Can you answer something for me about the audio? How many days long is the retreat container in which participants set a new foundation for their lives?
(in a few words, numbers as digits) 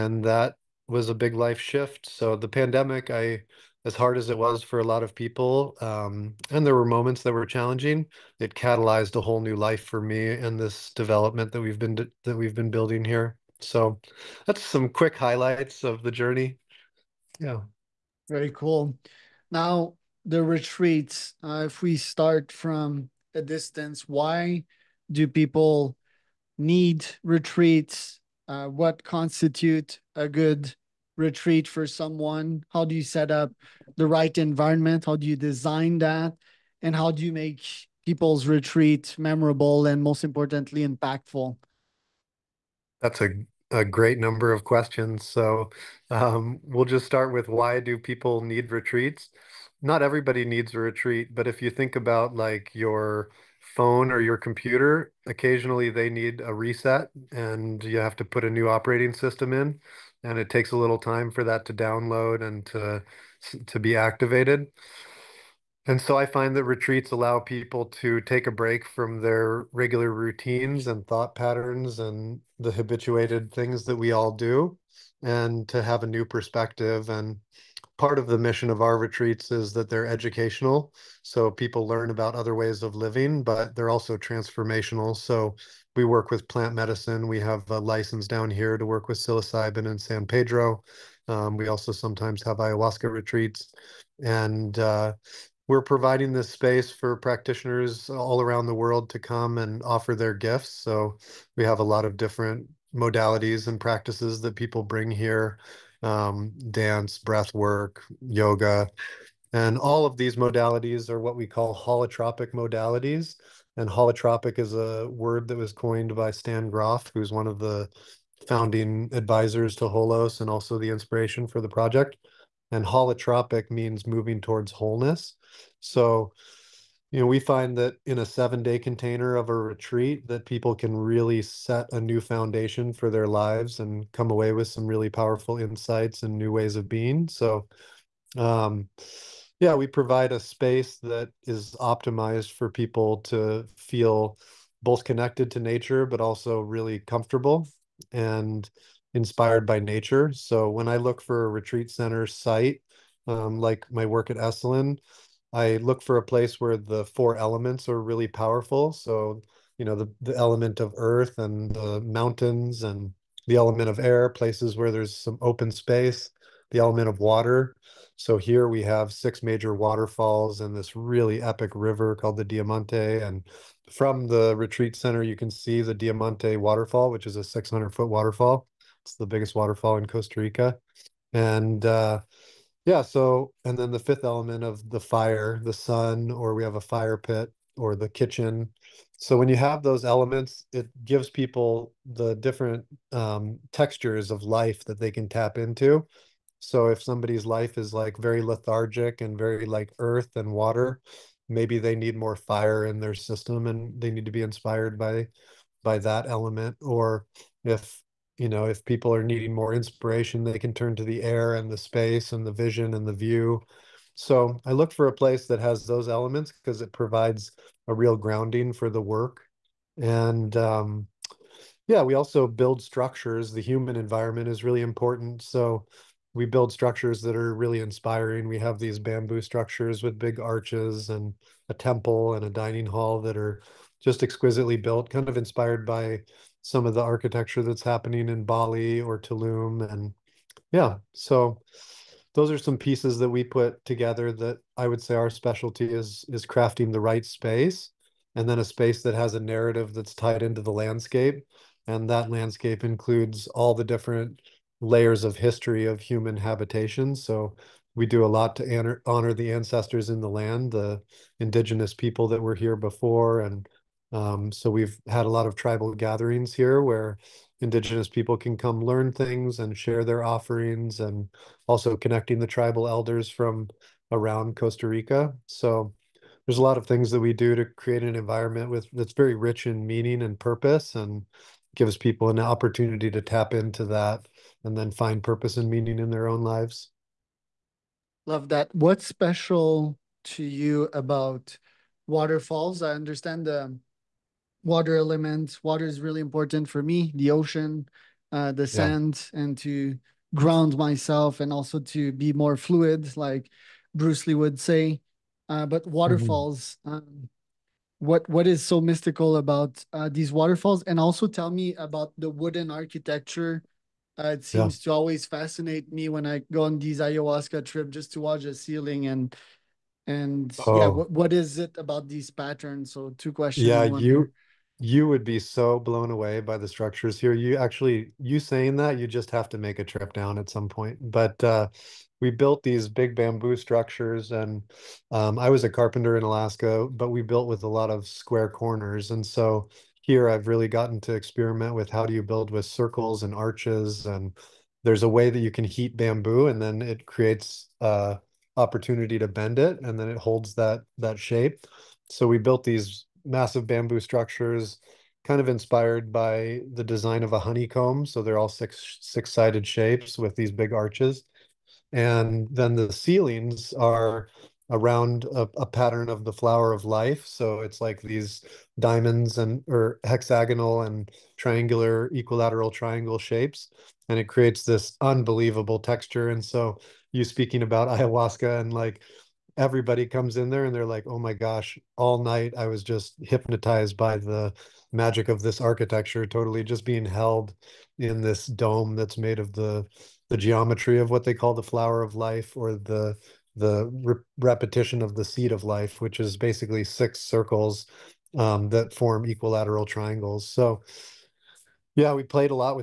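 7.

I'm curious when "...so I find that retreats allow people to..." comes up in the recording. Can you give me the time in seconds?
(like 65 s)
66 s.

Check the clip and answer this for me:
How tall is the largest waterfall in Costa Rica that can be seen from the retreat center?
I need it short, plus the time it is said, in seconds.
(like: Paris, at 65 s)
600 feet, at 177 s.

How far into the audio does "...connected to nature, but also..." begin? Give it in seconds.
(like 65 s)
145 s.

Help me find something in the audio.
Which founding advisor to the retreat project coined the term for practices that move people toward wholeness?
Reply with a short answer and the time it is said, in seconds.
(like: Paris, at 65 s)
Stan Grof, at 116 s.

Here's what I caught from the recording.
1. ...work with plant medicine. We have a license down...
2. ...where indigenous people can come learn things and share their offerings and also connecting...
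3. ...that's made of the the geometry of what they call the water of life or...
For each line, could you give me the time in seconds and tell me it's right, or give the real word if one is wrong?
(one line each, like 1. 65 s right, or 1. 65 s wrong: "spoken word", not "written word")
1. 86 s right
2. 266 s right
3. 388 s wrong: "flower", not "water".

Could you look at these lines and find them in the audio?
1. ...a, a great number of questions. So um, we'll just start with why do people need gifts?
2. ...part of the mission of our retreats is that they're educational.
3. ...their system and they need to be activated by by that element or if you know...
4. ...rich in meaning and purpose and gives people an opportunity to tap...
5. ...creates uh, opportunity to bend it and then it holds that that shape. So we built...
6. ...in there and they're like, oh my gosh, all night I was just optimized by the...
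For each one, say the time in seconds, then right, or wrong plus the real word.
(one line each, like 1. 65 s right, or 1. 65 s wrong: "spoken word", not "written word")
1. 43 s wrong: "retreats", not "gifts"
2. 77 s right
3. 203 s wrong: "inspired", not "activated"
4. 279 s right
5. 347 s right
6. 380 s wrong: "hypnotized", not "optimized".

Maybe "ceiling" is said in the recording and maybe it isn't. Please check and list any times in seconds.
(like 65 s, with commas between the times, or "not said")
318 s, 362 s.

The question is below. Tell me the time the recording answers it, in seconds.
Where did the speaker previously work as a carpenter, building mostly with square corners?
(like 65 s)
336 s.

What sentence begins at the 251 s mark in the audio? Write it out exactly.
And that landscape includes all the different layers of history of human habitation.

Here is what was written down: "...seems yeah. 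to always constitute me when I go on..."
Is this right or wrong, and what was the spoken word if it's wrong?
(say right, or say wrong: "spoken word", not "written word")
wrong: "fascinate", not "constitute".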